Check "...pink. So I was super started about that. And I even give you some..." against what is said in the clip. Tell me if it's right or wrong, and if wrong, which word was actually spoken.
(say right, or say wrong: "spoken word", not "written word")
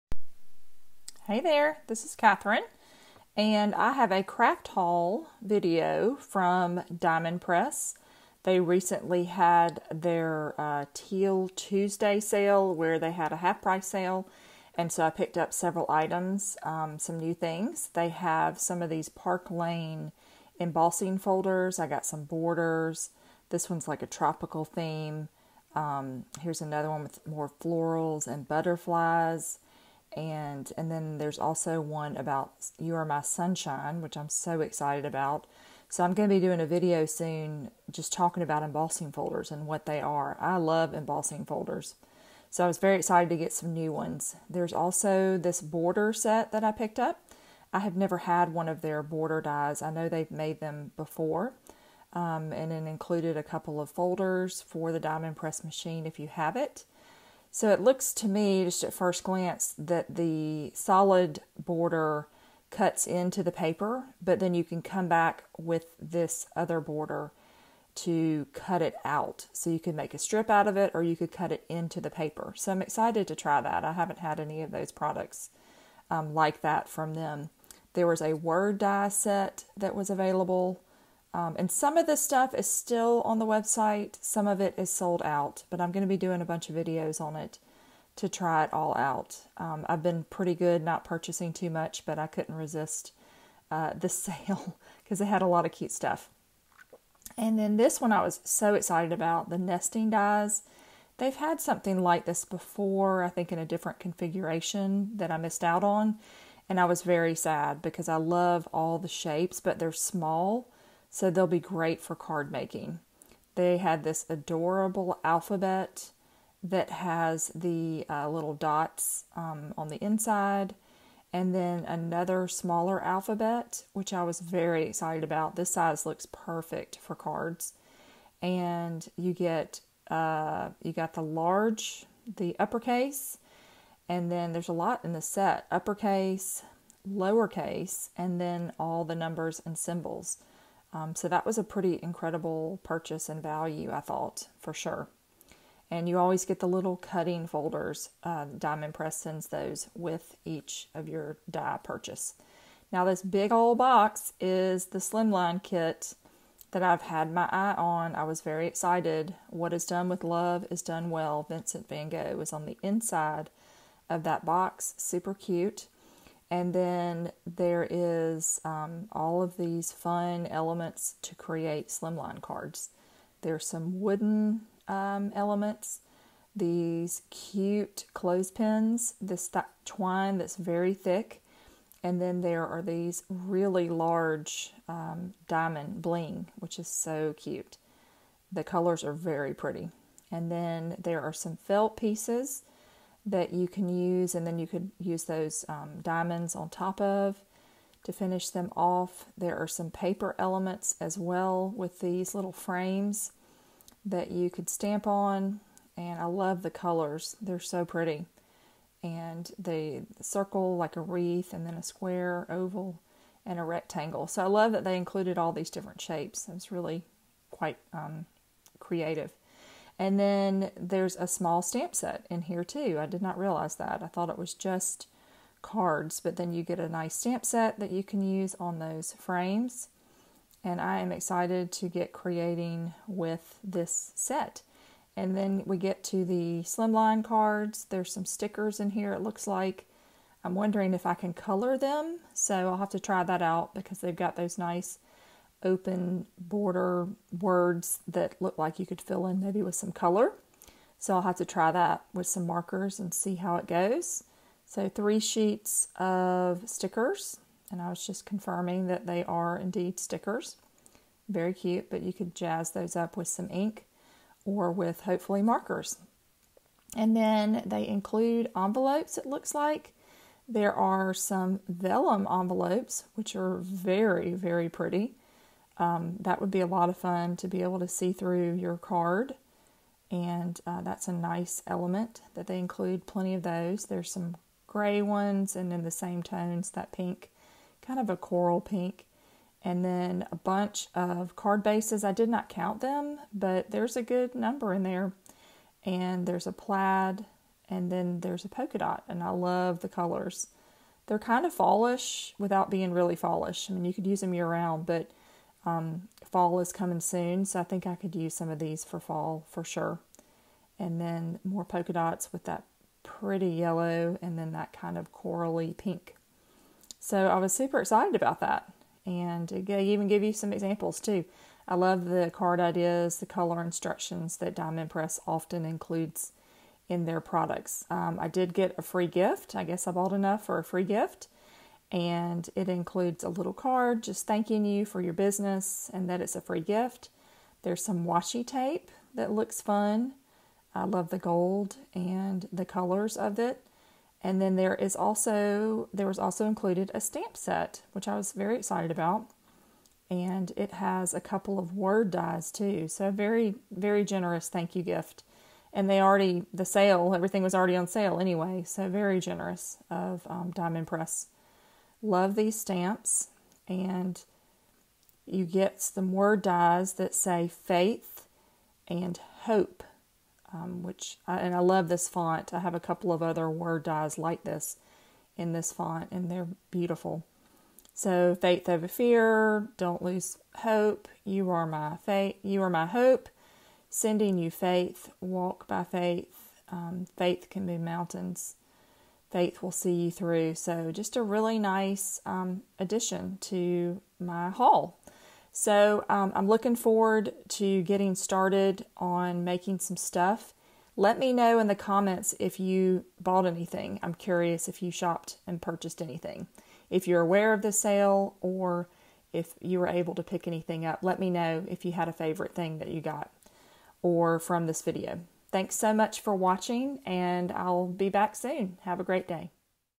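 wrong: "excited", not "started".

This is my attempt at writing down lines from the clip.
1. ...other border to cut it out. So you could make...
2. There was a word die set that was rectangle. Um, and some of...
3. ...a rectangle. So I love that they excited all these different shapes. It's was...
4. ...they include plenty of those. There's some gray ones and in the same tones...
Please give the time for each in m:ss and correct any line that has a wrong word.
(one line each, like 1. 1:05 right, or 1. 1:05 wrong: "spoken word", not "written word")
1. 1:06 right
2. 1:17 wrong: "available", not "rectangle"
3. 3:33 wrong: "included", not "excited"
4. 4:42 right.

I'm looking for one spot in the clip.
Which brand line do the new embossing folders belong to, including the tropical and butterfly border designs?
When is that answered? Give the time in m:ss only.
0:19.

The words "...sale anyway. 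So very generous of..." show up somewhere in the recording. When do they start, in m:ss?
5:57.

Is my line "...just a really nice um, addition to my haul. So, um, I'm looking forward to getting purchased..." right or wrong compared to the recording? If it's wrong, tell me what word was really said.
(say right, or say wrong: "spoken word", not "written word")
wrong: "started", not "purchased".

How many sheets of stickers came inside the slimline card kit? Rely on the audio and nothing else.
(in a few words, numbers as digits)
3.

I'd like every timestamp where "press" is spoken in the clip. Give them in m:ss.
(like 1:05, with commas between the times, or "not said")
0:07, 0:55, 2:28, 5:24, 6:00.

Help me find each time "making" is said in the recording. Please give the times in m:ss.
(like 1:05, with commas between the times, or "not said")
1:52, 6:39.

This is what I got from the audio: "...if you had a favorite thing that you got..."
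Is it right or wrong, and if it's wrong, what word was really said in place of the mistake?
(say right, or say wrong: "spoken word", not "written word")
right.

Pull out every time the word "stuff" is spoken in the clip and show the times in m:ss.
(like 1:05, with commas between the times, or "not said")
1:22, 1:35, 6:39.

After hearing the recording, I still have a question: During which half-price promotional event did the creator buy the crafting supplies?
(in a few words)
Teal Tuesday.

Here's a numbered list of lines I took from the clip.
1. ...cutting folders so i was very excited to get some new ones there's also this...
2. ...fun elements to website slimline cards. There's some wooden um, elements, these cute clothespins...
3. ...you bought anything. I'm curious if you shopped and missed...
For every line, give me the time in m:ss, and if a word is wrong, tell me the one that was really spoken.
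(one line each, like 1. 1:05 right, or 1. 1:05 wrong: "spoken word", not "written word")
1. 0:40 wrong: "embossing", not "cutting"
2. 2:49 wrong: "create", not "website"
3. 6:42 wrong: "purchased", not "missed".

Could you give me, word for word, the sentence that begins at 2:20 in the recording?
Um, so that was a pretty incredible purchase and value, I thought, for sure.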